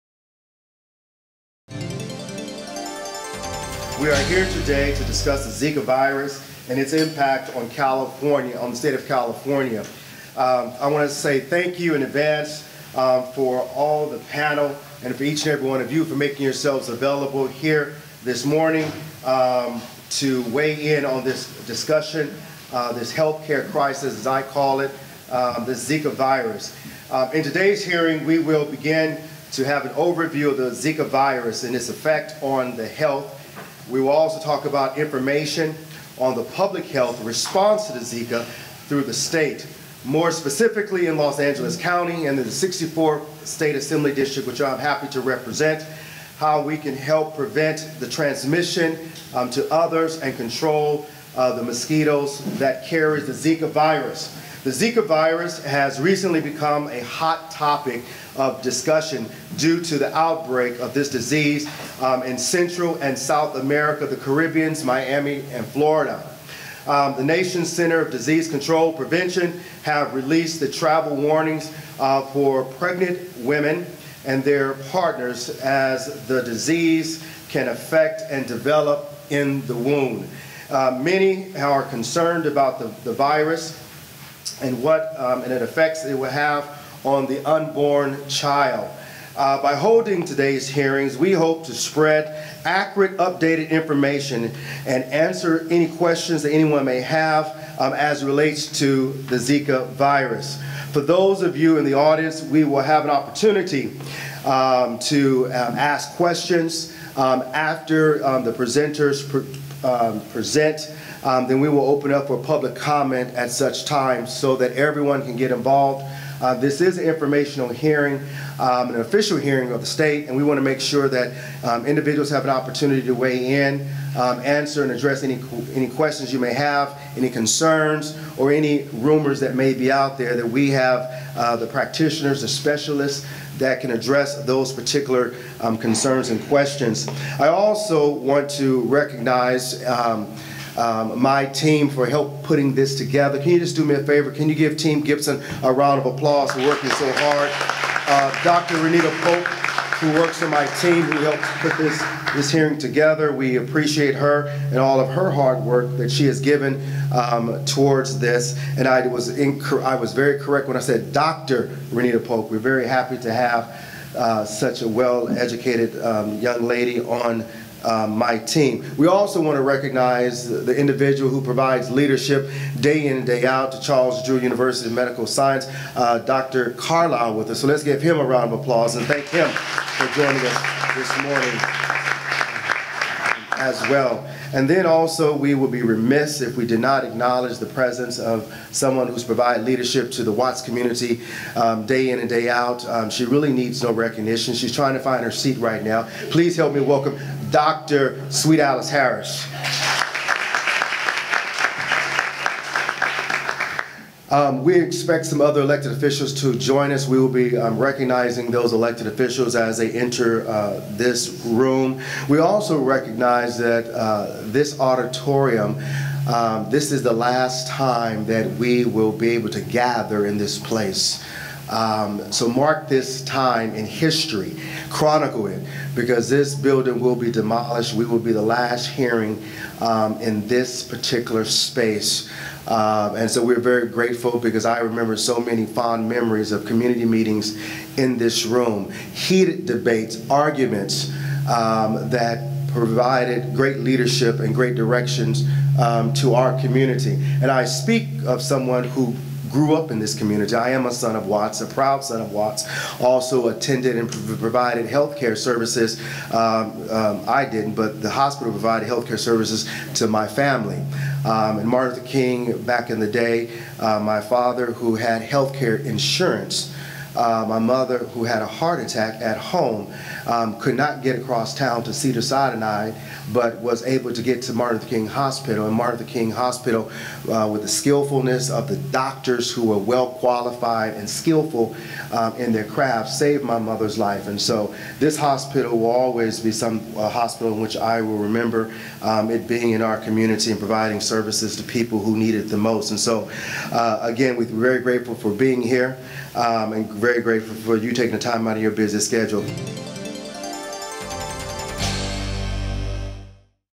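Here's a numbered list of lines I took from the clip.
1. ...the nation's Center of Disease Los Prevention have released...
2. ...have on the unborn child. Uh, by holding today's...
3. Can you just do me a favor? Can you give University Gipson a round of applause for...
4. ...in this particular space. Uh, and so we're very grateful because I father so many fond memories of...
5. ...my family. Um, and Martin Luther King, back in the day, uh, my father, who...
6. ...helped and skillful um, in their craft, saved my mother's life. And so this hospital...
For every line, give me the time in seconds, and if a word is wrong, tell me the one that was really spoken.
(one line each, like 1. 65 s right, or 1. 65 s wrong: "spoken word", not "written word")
1. 67 s wrong: "Control", not "Los"
2. 86 s right
3. 143 s wrong: "Team", not "University"
4. 230 s wrong: "remember", not "father"
5. 260 s right
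6. 280 s wrong: "qualified", not "helped".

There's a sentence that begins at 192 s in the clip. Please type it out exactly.
Um, she really needs no recognition.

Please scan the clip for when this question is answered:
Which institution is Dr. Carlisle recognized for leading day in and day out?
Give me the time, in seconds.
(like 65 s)
173 s.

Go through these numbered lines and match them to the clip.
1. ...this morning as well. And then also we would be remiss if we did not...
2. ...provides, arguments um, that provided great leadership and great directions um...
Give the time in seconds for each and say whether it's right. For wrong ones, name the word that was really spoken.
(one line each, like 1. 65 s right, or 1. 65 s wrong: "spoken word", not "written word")
1. 180 s right
2. 239 s wrong: "debates", not "provides".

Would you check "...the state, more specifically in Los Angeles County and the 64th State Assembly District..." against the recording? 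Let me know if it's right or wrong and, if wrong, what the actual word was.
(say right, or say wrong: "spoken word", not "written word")
right.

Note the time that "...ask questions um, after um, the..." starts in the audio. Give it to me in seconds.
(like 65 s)
105 s.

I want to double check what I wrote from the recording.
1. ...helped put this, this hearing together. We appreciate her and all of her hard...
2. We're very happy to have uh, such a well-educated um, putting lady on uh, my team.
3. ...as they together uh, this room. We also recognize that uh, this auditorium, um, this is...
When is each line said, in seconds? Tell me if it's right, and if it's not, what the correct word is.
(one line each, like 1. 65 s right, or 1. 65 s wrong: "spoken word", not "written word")
1. 151 s right
2. 162 s wrong: "young", not "putting"
3. 209 s wrong: "enter", not "together".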